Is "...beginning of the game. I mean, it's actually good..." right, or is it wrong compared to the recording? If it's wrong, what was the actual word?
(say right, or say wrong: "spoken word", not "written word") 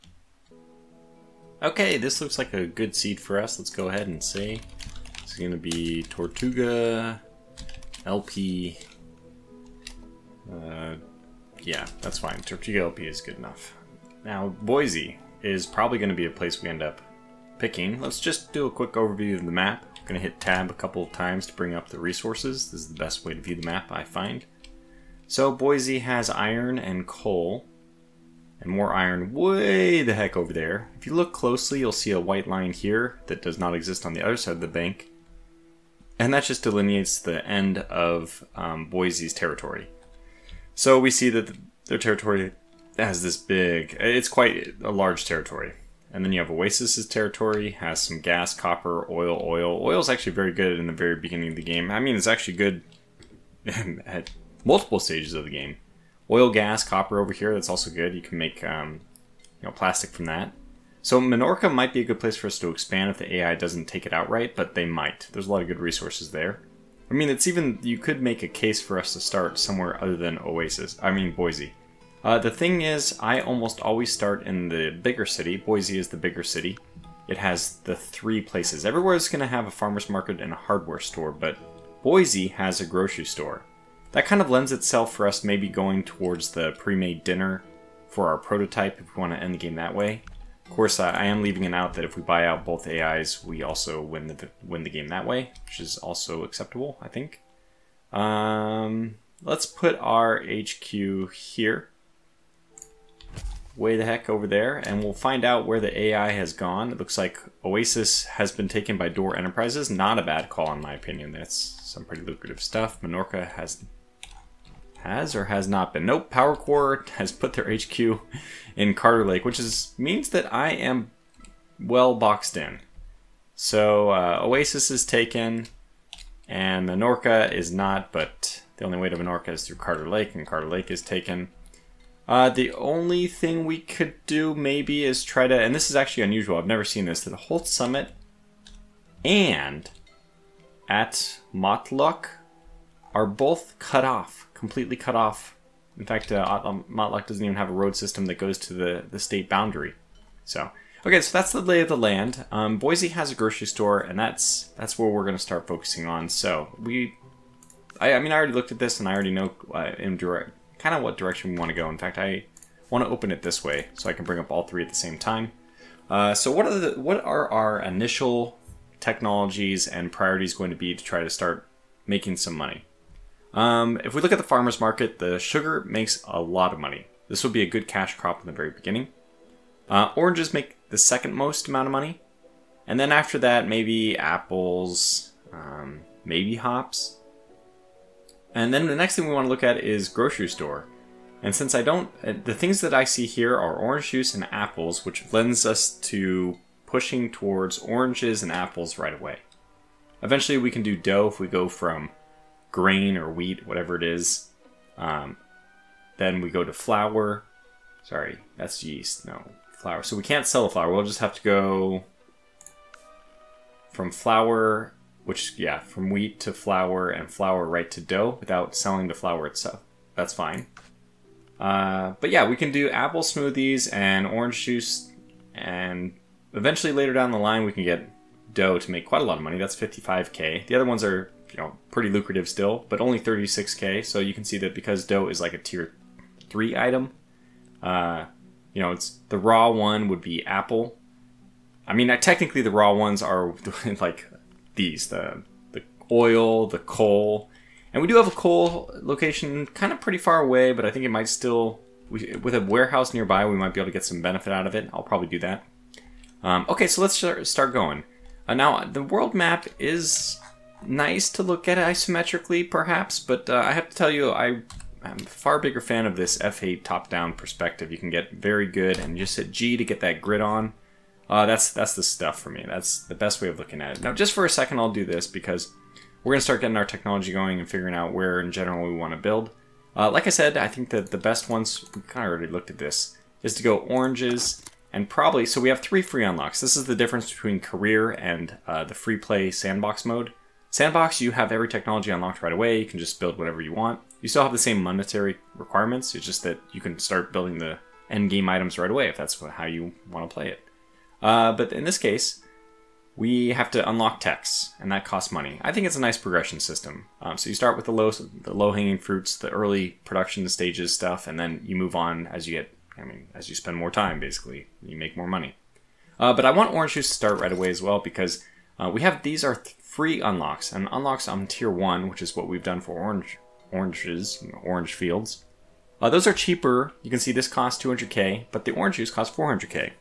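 right.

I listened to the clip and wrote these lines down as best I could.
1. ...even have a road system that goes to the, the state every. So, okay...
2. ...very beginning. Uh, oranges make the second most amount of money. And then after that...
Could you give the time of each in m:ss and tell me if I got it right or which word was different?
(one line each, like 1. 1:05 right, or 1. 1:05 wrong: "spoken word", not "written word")
1. 2:27 wrong: "boundary", not "every"
2. 2:58 right.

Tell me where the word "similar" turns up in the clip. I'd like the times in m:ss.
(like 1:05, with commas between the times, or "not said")
not said.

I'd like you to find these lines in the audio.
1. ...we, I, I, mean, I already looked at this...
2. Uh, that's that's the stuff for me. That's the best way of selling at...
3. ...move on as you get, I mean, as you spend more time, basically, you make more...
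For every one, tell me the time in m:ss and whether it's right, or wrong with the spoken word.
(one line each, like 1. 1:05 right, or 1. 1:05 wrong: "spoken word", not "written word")
1. 2:36 right
2. 4:31 wrong: "looking", not "selling"
3. 5:11 right.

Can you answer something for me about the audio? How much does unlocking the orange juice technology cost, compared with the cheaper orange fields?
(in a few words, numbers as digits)
400k.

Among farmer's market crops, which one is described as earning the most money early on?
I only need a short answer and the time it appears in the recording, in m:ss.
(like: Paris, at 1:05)
Sugar, at 2:55.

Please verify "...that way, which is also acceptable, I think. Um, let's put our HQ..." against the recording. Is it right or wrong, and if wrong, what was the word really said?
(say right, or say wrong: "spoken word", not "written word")
right.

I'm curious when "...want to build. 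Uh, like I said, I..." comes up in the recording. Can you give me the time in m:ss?
4:38.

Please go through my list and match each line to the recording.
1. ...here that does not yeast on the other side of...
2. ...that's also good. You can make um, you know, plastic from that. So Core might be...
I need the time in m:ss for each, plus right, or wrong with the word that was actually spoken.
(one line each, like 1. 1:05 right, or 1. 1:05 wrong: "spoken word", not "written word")
1. 0:32 wrong: "exist", not "yeast"
2. 0:57 wrong: "Minorca", not "Core".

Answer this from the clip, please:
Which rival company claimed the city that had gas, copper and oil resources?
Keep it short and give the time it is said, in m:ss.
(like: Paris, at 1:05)
Door Enterprises, at 1:49.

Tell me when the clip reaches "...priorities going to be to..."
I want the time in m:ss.
2:50.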